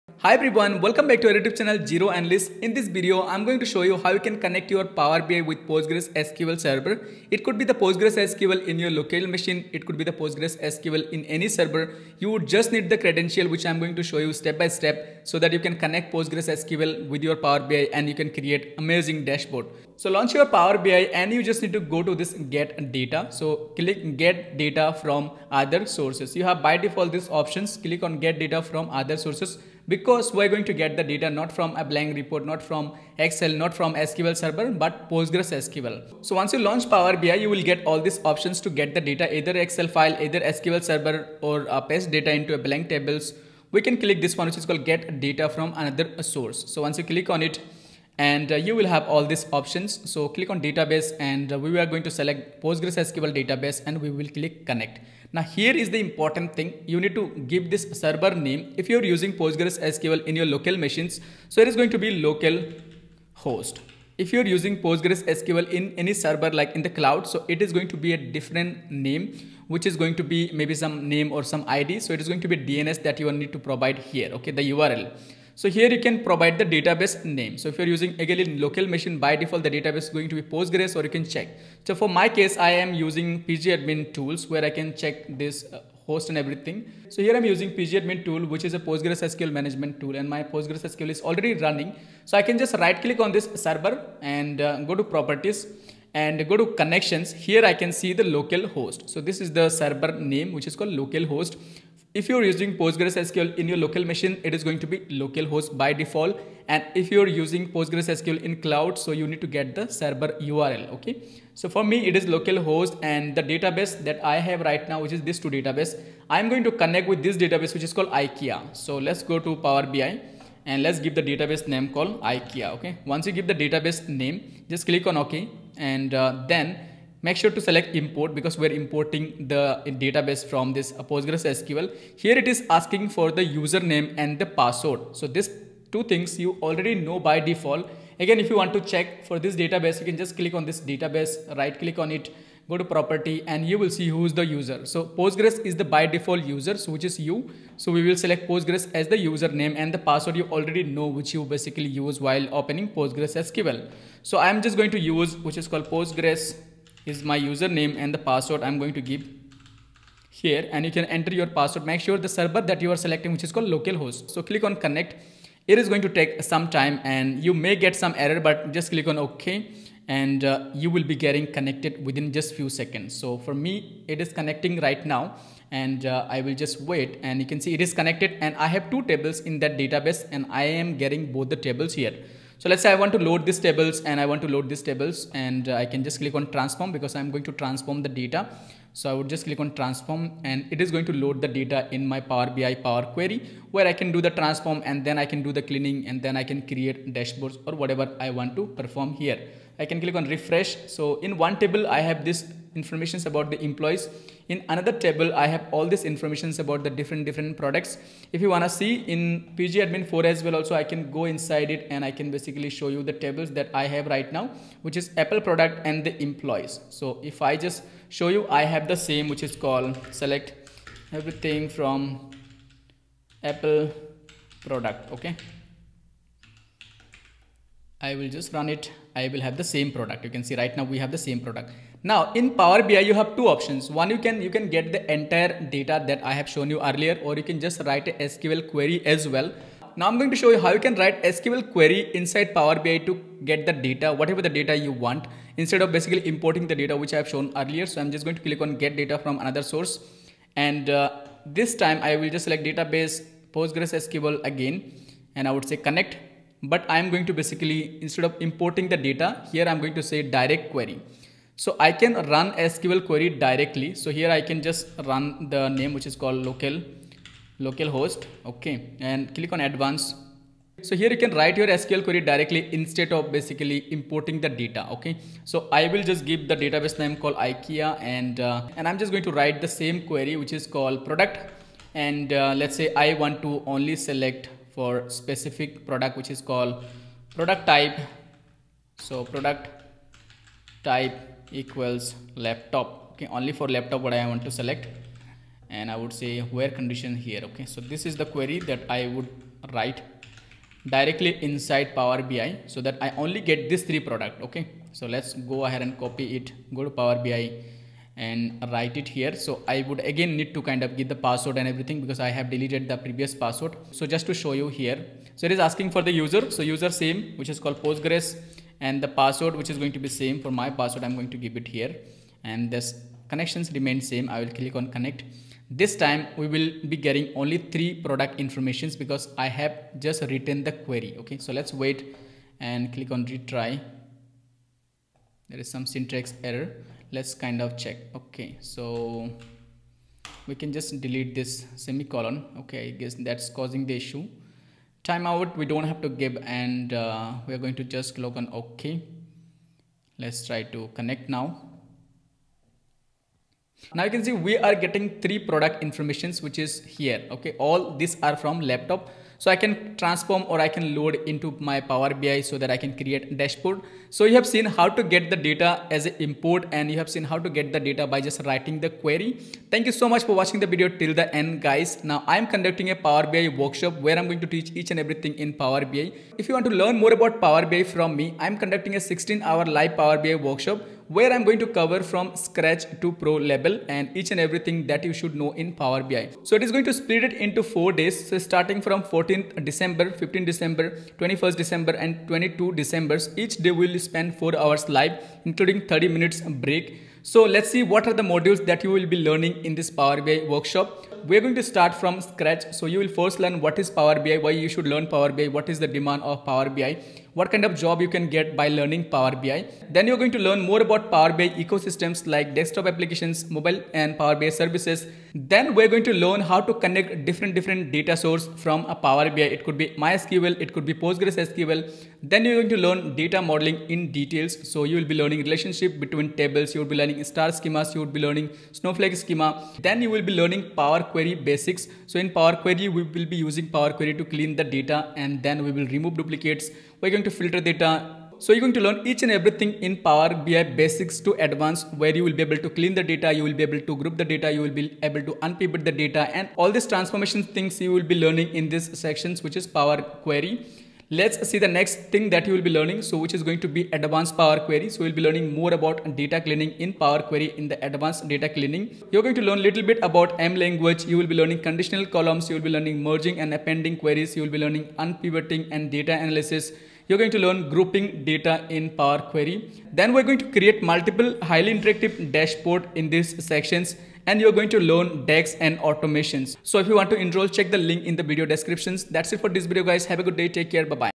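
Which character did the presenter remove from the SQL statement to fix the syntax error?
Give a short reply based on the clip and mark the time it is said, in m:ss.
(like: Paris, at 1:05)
semicolon, at 5:41.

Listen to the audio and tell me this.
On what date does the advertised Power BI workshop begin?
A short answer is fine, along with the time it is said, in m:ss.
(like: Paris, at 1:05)
14 December, at 6:29.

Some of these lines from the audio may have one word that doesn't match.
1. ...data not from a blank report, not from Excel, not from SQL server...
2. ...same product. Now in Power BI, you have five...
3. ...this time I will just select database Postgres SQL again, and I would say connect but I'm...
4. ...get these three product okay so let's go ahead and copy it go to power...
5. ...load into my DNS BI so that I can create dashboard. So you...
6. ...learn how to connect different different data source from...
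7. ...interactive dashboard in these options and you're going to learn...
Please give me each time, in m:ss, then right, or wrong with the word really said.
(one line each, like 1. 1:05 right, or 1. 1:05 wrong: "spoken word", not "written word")
1. 0:31 right
2. 3:51 wrong: "two", not "five"
3. 4:11 right
4. 5:03 right
5. 6:00 wrong: "Power", not "DNS"
6. 6:56 right
7. 7:51 wrong: "sections", not "options".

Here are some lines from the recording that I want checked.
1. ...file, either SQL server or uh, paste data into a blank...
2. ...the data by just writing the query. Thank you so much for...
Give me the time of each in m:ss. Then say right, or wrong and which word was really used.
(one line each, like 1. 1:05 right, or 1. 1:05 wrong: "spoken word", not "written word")
1. 0:39 right
2. 6:07 right.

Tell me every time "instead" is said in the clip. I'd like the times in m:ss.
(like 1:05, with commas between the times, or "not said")
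4:05, 4:18, 4:32.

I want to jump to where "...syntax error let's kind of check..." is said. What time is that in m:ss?
5:35.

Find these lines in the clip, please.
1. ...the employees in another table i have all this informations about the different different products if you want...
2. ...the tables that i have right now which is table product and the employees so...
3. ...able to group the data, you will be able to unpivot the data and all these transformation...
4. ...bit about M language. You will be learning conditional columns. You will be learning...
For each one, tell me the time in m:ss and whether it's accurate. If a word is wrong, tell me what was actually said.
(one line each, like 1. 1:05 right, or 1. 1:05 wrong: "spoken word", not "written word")
1. 3:23 right
2. 3:33 wrong: "apple", not "table"
3. 7:23 right
4. 7:39 right.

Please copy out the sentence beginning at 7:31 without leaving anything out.
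Let's see the next thing that you will be learning.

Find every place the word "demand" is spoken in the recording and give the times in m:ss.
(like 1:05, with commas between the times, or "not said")
6:45.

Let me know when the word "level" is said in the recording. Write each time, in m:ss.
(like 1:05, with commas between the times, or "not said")
6:23.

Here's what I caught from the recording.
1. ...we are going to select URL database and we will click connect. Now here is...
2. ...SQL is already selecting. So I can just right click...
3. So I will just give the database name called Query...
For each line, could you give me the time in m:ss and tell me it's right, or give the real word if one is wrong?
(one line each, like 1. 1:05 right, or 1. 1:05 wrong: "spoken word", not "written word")
1. 0:51 wrong: "PostgreSQL", not "URL"
2. 1:30 wrong: "running", not "selecting"
3. 4:35 wrong: "IKEA", not "Query".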